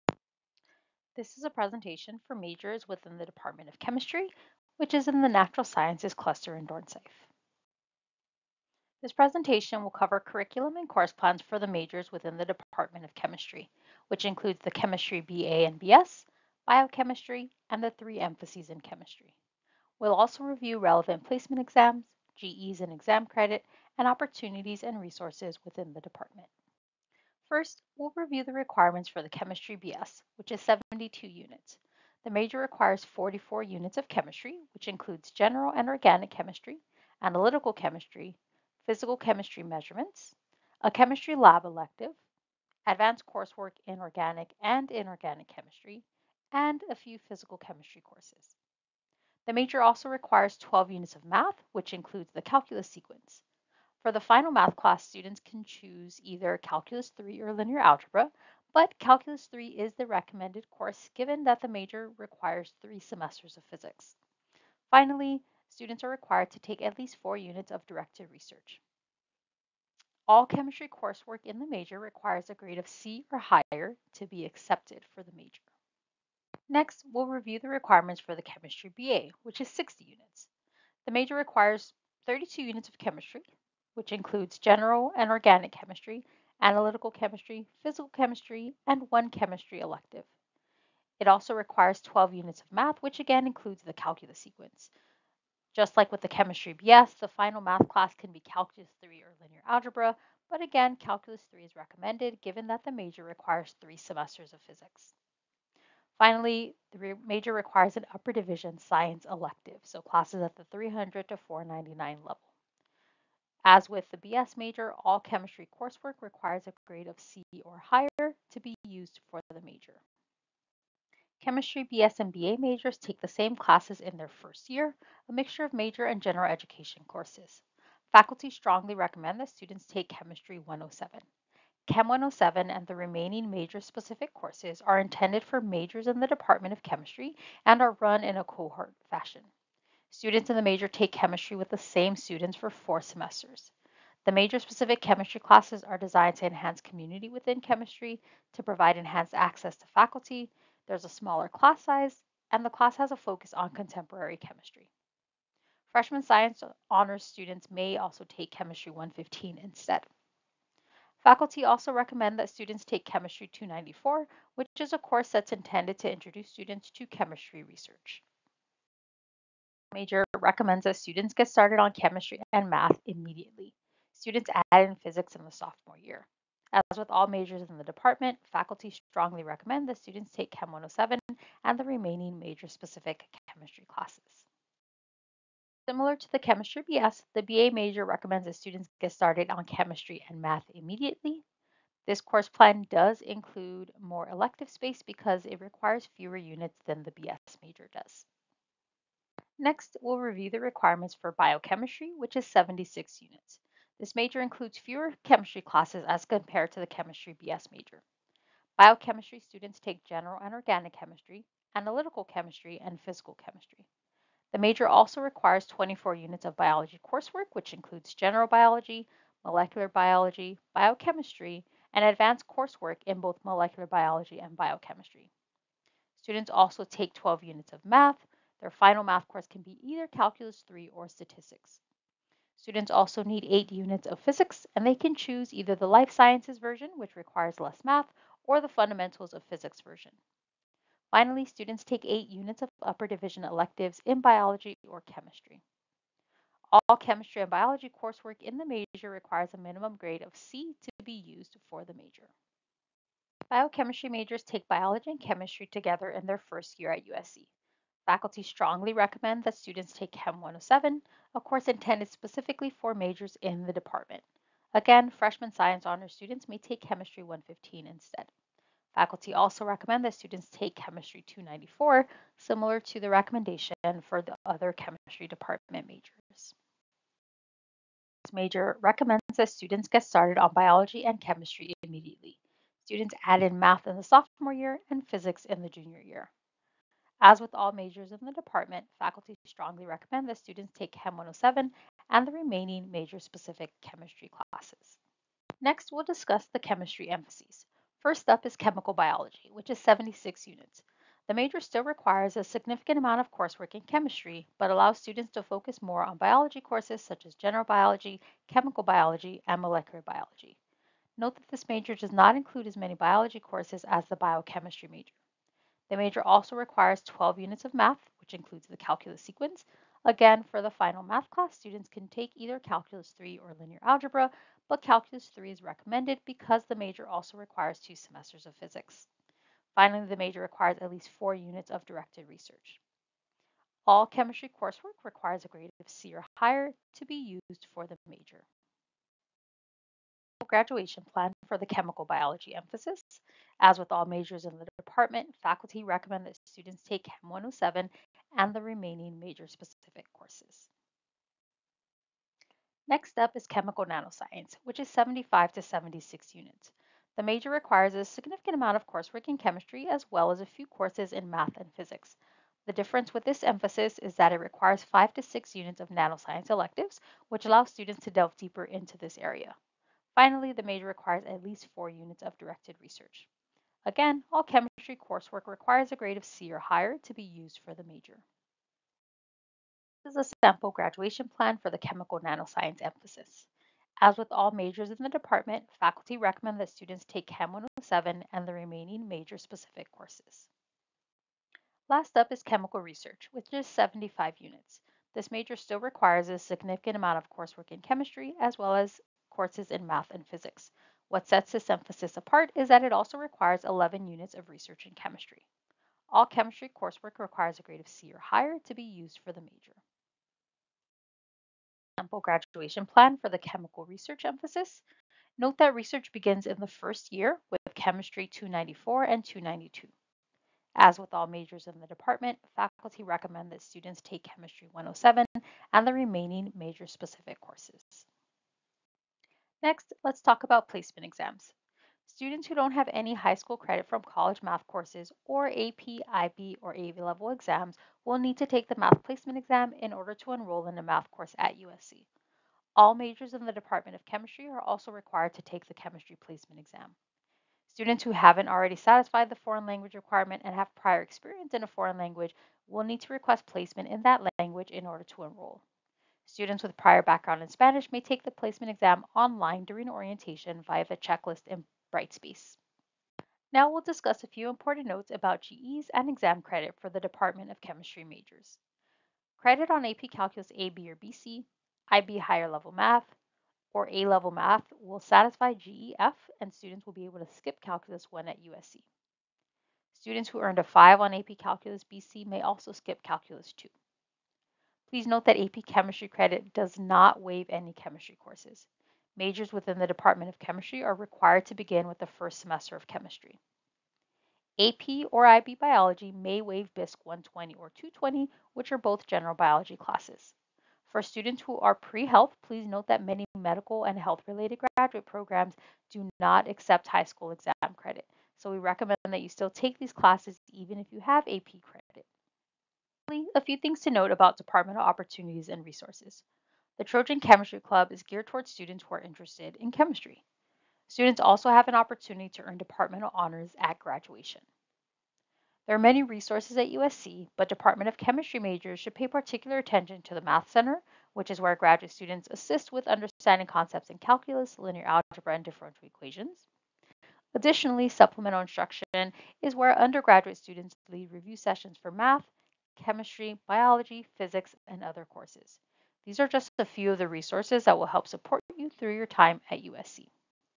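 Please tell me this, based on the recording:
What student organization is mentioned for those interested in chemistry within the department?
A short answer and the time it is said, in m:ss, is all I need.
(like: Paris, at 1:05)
Trojan Chemistry Club, at 8:36.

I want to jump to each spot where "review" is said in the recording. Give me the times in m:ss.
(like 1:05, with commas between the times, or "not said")
0:20, 0:28, 1:17, 3:20, 9:01.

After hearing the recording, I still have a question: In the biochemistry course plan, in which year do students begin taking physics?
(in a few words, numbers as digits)
junior year.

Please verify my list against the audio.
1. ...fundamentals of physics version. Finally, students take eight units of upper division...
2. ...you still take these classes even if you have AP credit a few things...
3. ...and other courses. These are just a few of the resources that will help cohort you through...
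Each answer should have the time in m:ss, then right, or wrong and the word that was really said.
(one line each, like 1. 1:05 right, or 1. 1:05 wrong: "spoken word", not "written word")
1. 3:58 right
2. 8:29 right
3. 9:04 wrong: "support", not "cohort".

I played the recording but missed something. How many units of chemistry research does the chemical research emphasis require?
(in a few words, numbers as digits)
11.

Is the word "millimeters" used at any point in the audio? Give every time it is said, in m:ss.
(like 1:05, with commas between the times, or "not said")
not said.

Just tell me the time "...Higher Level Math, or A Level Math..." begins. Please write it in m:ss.
7:52.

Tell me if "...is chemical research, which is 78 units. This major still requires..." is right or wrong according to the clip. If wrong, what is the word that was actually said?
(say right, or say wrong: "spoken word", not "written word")
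wrong: "75", not "78".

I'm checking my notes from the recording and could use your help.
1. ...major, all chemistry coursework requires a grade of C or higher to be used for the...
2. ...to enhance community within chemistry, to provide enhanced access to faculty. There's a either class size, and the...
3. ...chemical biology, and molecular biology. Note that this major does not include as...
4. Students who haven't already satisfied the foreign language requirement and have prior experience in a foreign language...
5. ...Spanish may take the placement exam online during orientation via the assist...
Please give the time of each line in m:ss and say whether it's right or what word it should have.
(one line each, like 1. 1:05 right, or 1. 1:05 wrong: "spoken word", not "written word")
1. 1:54 right
2. 2:26 wrong: "smaller", not "either"
3. 5:08 right
4. 7:27 right
5. 7:37 wrong: "checklist", not "assist".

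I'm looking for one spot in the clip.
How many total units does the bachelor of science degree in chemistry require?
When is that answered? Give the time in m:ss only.
0:30.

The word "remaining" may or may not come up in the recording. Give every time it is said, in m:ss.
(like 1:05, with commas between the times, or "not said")
2:12, 3:01, 4:52, 5:48, 6:28, 7:05.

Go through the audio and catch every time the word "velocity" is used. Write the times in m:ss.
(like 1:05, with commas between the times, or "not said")
not said.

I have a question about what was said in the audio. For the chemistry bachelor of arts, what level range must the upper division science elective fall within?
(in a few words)
300 to 499.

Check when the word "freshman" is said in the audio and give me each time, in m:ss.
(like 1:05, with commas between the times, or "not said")
2:35, 4:25.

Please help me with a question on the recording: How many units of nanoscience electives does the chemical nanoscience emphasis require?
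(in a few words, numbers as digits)
5 to 6.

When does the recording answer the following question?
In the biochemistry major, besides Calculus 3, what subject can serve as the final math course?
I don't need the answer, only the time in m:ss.
3:51.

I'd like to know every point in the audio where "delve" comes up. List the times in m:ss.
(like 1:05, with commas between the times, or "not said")
6:08.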